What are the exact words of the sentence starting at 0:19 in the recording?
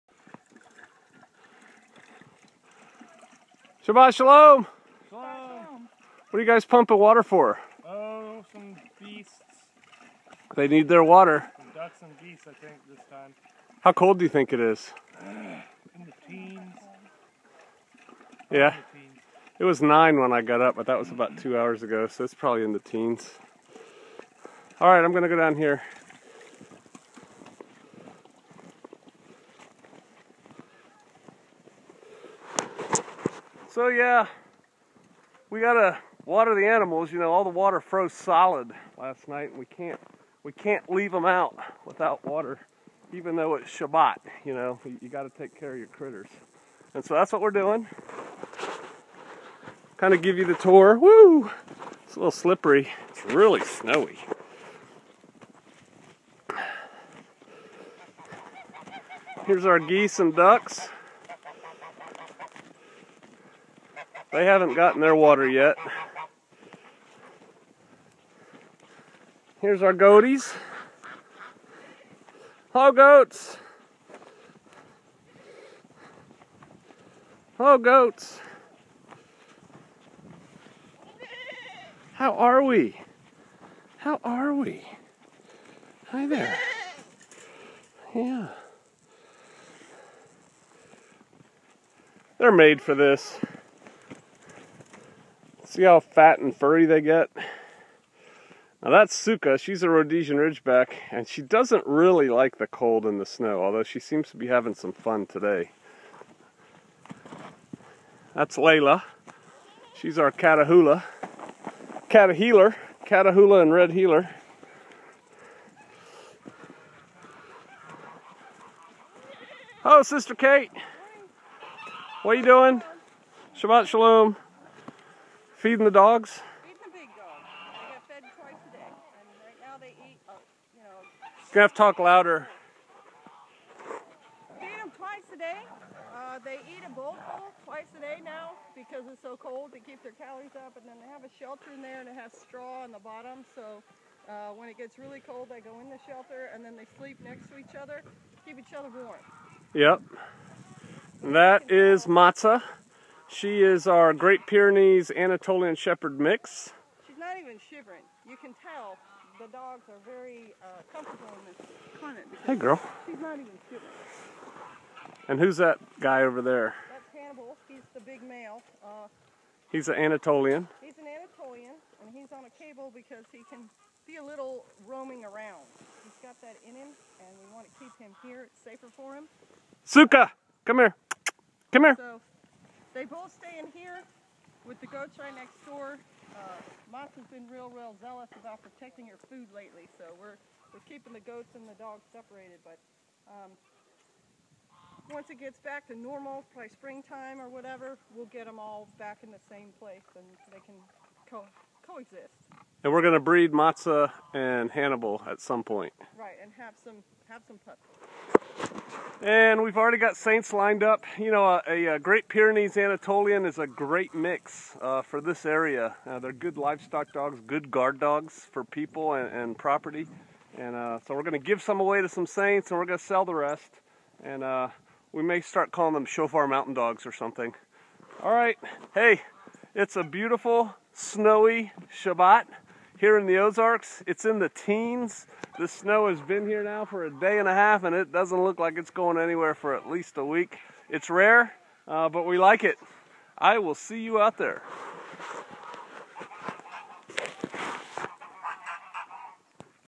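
It was 9 when I got up, but that was about two hours ago, so it's probably in the teens.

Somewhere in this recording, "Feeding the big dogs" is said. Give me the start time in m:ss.
2:06.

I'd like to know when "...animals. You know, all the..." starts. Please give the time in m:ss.
0:36.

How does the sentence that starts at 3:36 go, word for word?
Uh, they're good livestock dogs, good guard dogs for people and, and property.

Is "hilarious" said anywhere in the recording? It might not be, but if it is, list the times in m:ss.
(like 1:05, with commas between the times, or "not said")
not said.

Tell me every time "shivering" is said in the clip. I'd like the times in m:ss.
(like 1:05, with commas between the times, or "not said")
2:37, 2:43.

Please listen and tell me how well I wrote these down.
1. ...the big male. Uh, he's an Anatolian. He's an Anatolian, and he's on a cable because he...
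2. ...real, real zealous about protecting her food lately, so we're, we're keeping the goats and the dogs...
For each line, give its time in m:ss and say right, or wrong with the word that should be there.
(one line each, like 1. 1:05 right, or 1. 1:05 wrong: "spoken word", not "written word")
1. 2:47 right
2. 3:07 right.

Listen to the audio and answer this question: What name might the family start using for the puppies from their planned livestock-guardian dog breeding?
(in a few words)
shofar mountain dogs.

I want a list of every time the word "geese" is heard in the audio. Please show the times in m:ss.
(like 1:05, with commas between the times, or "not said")
0:12, 0:59.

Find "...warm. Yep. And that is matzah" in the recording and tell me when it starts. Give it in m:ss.
2:28.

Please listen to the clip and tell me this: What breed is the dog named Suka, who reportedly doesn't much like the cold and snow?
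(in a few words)
Rhodesian Ridgeback.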